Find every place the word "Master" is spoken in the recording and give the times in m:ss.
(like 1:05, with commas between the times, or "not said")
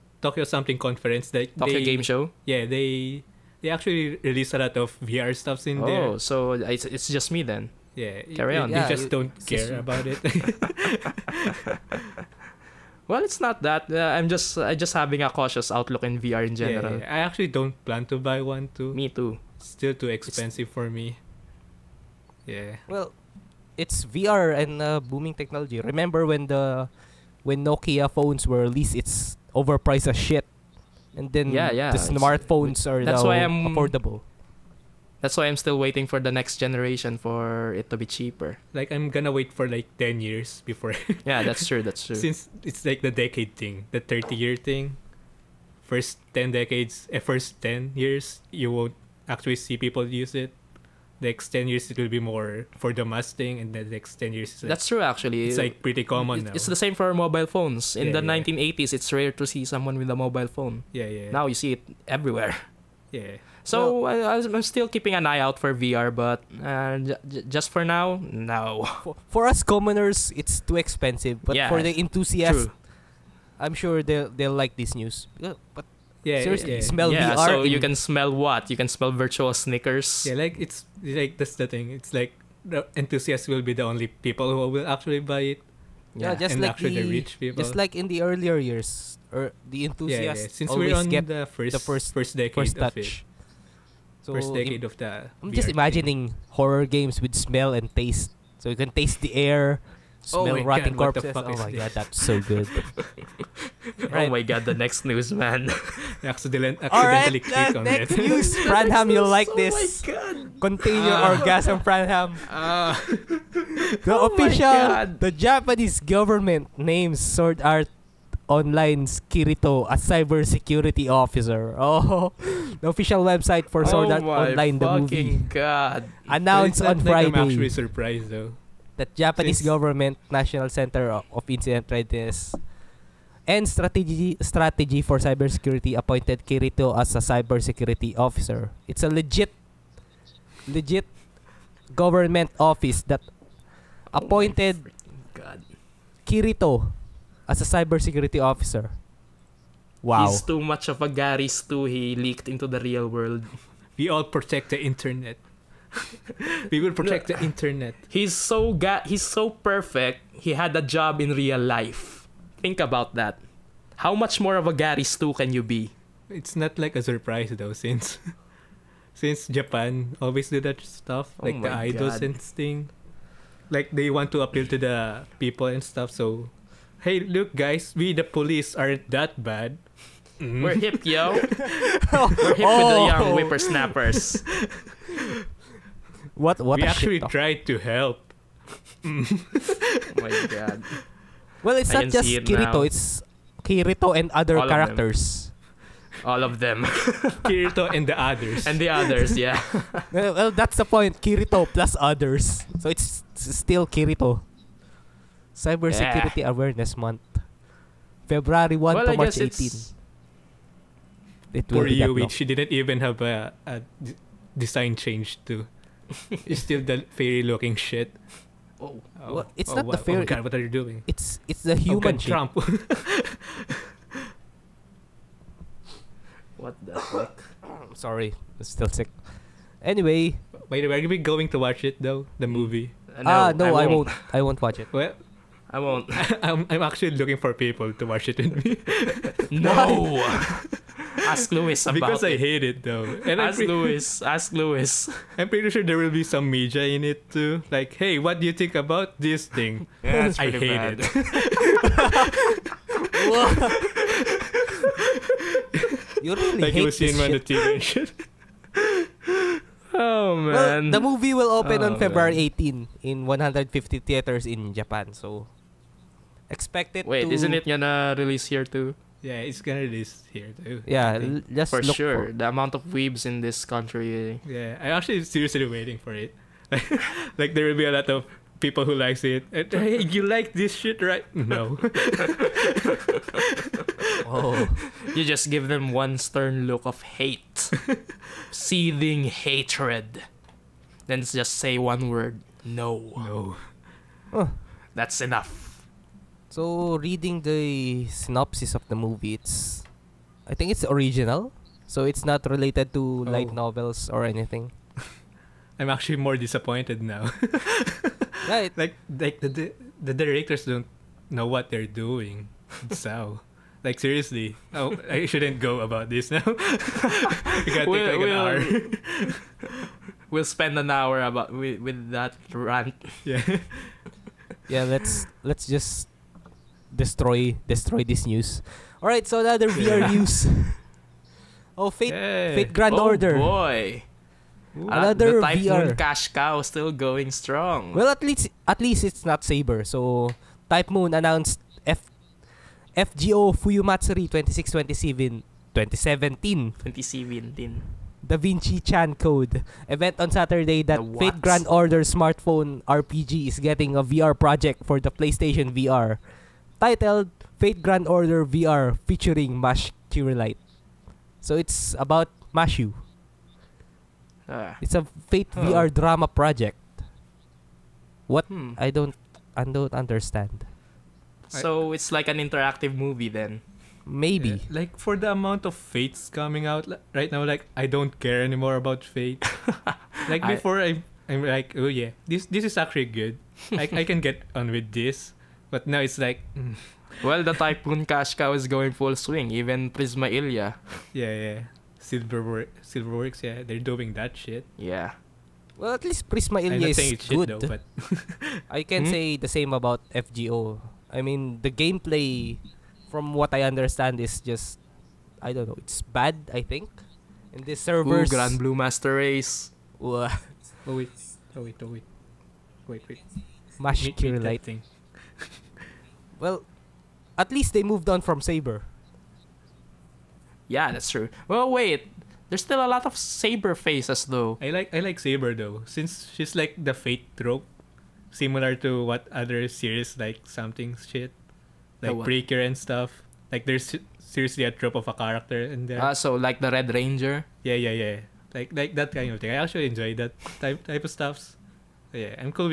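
6:48.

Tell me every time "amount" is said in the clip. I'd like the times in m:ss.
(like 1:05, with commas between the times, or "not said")
4:32, 6:15.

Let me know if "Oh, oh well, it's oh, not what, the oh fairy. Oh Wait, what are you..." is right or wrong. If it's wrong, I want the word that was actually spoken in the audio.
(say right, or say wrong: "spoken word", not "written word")
wrong: "God", not "Wait".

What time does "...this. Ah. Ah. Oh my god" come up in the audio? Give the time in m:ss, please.
1:49.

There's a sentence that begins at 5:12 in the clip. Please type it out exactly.
so like seriously, oh, I shouldn't go about this now.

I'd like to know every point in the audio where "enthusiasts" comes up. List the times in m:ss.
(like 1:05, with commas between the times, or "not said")
1:11, 1:22, 1:29.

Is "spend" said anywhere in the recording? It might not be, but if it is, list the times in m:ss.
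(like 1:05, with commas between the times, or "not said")
5:20.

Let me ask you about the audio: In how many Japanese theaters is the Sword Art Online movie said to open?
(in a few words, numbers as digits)
150.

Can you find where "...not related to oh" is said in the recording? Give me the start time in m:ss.
5:02.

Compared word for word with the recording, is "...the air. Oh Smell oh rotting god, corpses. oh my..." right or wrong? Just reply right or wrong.
right.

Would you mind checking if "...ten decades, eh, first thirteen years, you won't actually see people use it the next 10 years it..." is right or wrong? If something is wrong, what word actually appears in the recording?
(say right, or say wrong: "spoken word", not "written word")
wrong: "ten", not "thirteen".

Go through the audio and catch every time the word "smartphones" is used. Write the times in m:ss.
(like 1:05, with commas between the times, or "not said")
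0:31, 5:52.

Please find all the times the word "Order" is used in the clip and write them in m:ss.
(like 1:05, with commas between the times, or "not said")
5:33, 5:51, 5:58.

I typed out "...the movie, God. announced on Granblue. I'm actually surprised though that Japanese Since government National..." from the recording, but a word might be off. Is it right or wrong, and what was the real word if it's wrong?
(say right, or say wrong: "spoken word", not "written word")
wrong: "Friday", not "Granblue".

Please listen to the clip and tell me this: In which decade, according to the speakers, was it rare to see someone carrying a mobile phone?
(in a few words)
1980s.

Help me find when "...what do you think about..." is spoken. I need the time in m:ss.
4:08.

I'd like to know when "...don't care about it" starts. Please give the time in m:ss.
0:09.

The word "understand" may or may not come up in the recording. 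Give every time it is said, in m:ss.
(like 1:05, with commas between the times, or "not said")
6:09, 6:43.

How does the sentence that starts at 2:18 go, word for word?
It's a legit legit government office that appointed Kirito as a cybersecurity officer.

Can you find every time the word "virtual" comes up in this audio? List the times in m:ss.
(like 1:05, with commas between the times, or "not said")
1:19.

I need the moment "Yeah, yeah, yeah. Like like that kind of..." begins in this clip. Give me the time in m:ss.
7:17.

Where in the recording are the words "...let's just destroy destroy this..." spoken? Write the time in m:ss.
5:25.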